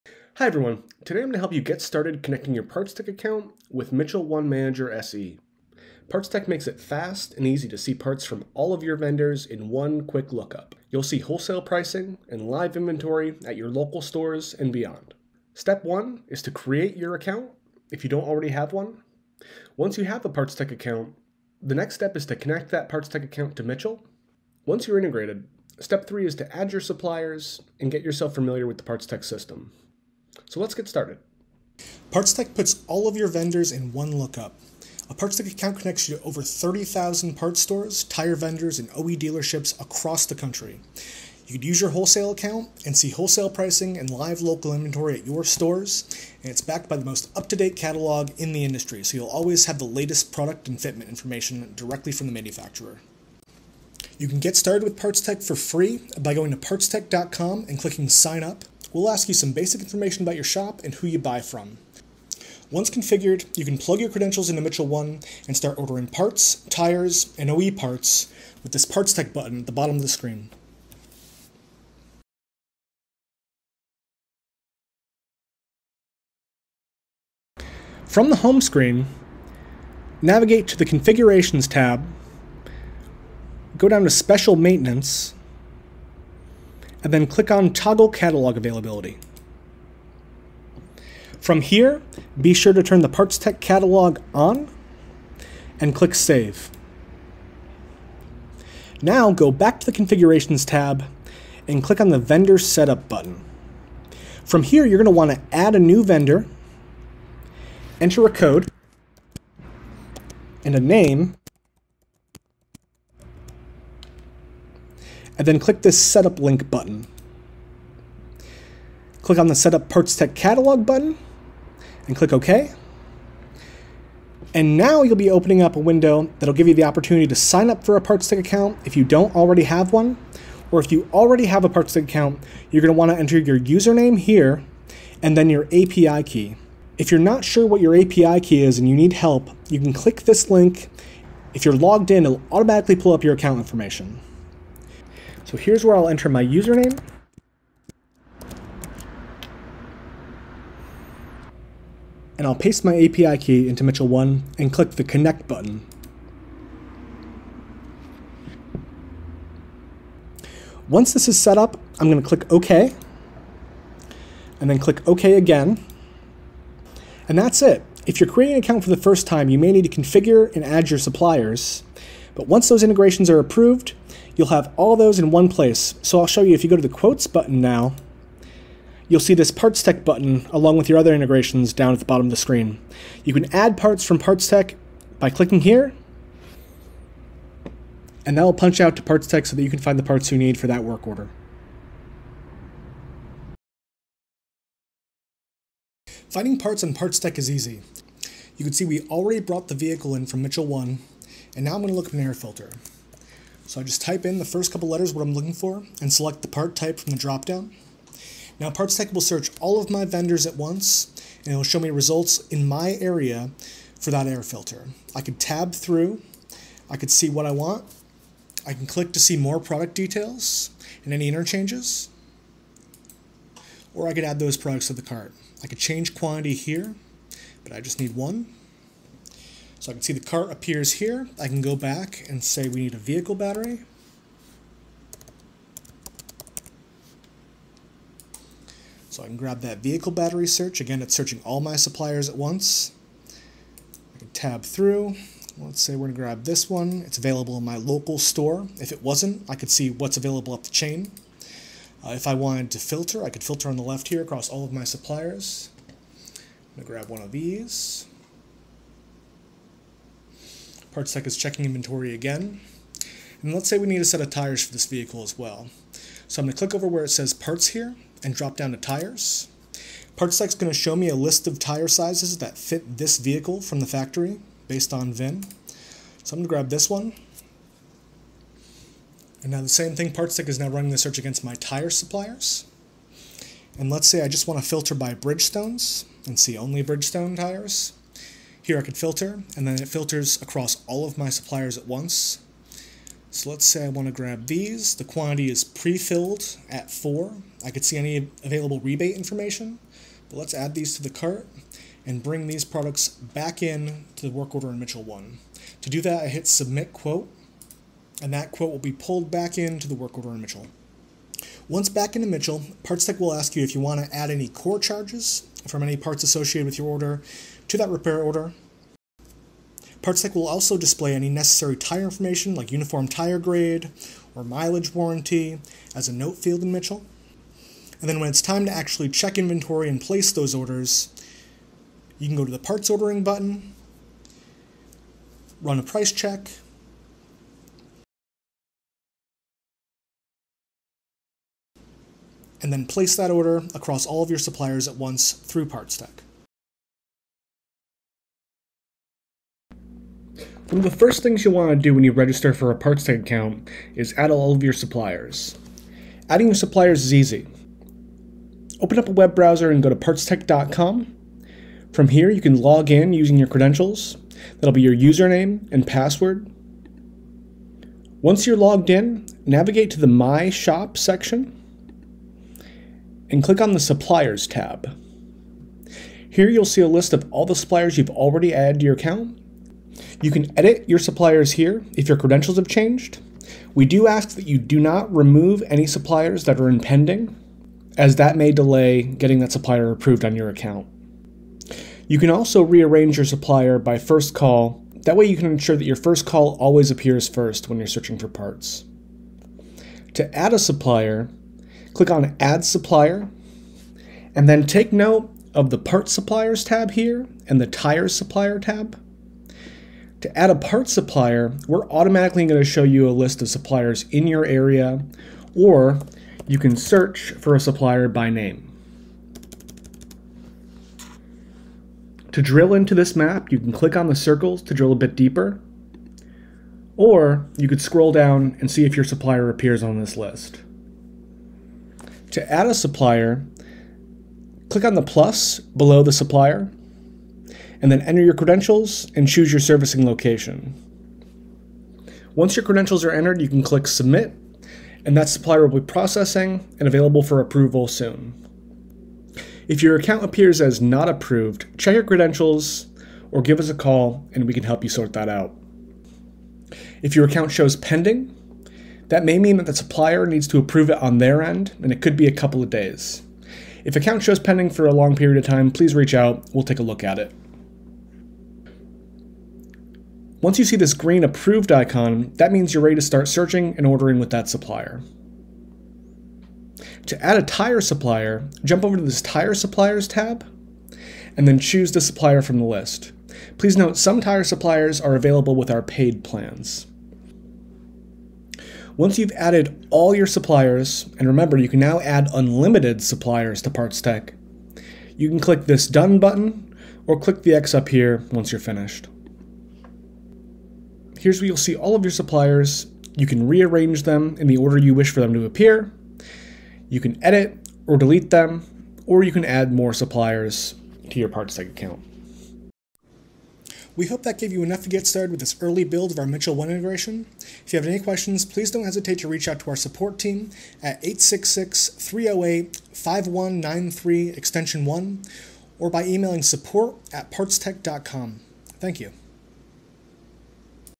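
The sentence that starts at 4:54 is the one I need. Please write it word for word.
The quantity is pre-filled at 4.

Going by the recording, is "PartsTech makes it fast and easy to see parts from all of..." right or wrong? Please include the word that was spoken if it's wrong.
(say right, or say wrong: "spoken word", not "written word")
right.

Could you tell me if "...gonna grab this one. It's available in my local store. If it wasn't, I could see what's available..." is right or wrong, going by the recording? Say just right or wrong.
right.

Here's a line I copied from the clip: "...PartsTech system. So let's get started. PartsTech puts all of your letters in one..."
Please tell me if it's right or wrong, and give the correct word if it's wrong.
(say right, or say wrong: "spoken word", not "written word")
wrong: "vendors", not "letters".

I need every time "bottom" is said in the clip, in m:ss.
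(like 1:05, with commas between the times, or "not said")
1:09, 3:02.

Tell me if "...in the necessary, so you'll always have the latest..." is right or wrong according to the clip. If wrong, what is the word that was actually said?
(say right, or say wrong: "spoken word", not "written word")
wrong: "industry", not "necessary".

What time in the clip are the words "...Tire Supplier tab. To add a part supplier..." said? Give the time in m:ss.
6:47.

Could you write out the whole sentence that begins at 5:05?
To do that, I hit Submit Quote, and that quote will be pulled back into the work order in Mitchell.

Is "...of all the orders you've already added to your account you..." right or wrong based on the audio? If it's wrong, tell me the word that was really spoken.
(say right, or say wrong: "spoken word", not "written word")
wrong: "suppliers", not "orders".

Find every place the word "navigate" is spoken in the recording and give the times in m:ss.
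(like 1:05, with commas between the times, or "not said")
1:20, 6:09.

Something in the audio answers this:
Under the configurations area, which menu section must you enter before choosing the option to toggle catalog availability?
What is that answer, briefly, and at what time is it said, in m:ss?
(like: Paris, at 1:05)
Special Maintenance, at 1:24.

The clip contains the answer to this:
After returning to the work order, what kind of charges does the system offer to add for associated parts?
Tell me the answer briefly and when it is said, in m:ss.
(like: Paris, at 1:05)
Core charges, at 5:14.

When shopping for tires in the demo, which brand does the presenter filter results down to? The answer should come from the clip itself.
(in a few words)
Bridgestone.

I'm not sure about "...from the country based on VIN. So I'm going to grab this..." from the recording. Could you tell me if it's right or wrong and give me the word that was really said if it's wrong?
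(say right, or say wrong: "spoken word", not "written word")
wrong: "factory", not "country".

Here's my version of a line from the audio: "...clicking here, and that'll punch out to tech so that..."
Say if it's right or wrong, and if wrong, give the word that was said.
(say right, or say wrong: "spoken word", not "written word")
right.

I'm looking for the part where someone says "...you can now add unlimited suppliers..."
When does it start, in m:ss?
8:11.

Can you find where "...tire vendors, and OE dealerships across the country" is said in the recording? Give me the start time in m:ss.
0:38.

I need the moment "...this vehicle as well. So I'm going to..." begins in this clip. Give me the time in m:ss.
4:24.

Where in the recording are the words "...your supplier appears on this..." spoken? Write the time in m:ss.
7:08.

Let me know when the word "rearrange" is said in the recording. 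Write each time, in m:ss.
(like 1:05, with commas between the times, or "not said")
6:32, 8:23.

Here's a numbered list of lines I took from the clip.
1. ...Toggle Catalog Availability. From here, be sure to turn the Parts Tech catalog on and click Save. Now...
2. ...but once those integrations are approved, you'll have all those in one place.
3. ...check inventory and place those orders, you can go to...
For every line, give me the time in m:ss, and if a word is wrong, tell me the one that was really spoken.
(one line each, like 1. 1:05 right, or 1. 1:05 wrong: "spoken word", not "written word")
1. 1:27 right
2. 2:52 right
3. 5:29 right.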